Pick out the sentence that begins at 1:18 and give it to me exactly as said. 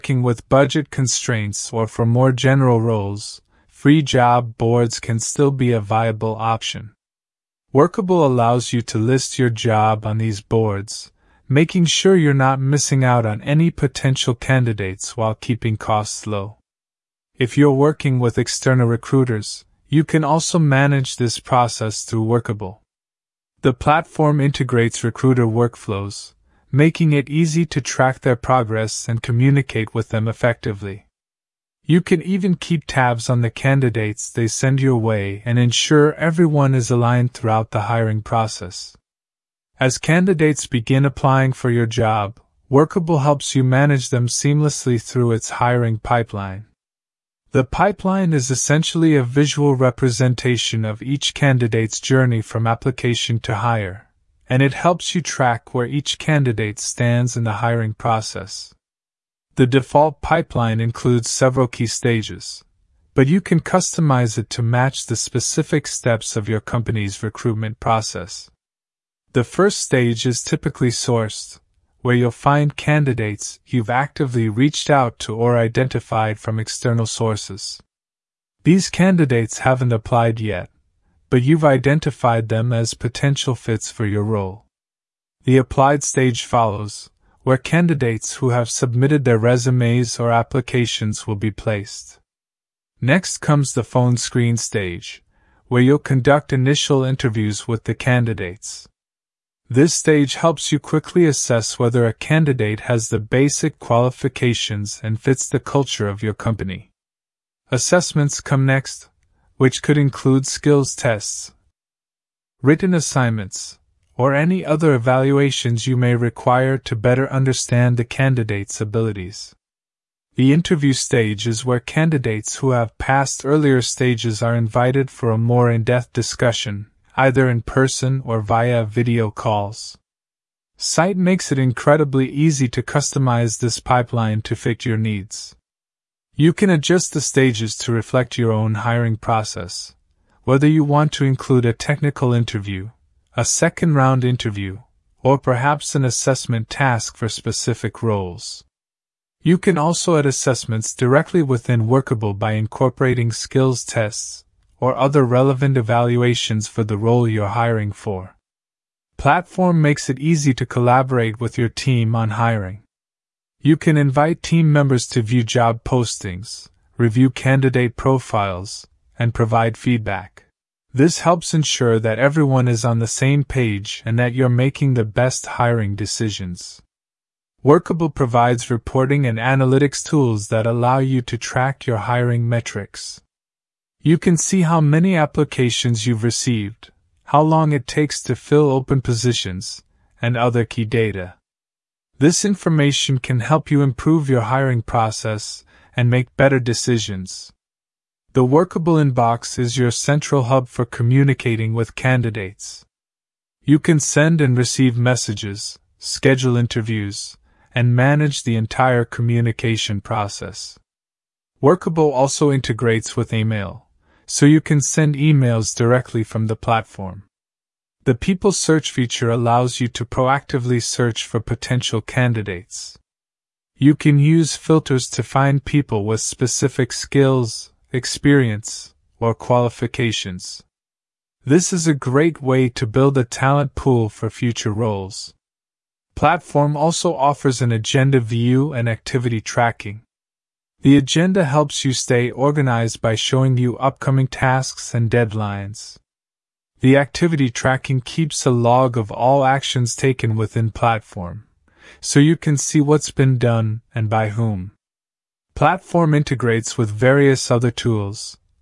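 These candidates haven't applied yet, but you've identified them as potential fits for your role.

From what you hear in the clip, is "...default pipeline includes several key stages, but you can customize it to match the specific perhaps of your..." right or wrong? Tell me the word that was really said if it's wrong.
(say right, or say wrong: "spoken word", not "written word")
wrong: "steps", not "perhaps".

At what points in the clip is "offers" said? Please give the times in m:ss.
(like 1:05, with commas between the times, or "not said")
3:57.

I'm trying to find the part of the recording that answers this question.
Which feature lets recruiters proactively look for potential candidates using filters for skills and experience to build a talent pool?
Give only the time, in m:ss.
3:38.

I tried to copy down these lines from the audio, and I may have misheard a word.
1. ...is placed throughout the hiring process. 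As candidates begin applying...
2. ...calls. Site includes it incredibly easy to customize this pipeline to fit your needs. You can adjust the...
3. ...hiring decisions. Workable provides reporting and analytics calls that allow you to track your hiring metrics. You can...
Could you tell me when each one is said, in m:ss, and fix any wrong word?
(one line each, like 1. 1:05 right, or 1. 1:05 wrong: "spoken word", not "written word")
1. 0:36 wrong: "aligned", not "placed"
2. 2:09 wrong: "makes", not "includes"
3. 2:55 wrong: "tools", not "calls".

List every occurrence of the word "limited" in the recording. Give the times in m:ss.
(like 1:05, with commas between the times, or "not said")
not said.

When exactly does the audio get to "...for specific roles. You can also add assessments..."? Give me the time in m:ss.
2:27.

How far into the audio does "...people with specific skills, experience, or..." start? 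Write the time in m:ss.
3:45.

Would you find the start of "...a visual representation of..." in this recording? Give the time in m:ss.
0:49.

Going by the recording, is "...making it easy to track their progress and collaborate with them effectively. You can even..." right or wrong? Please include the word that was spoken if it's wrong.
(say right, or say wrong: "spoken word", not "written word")
wrong: "communicate", not "collaborate".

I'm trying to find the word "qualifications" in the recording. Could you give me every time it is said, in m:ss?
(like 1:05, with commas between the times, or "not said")
1:43, 3:49.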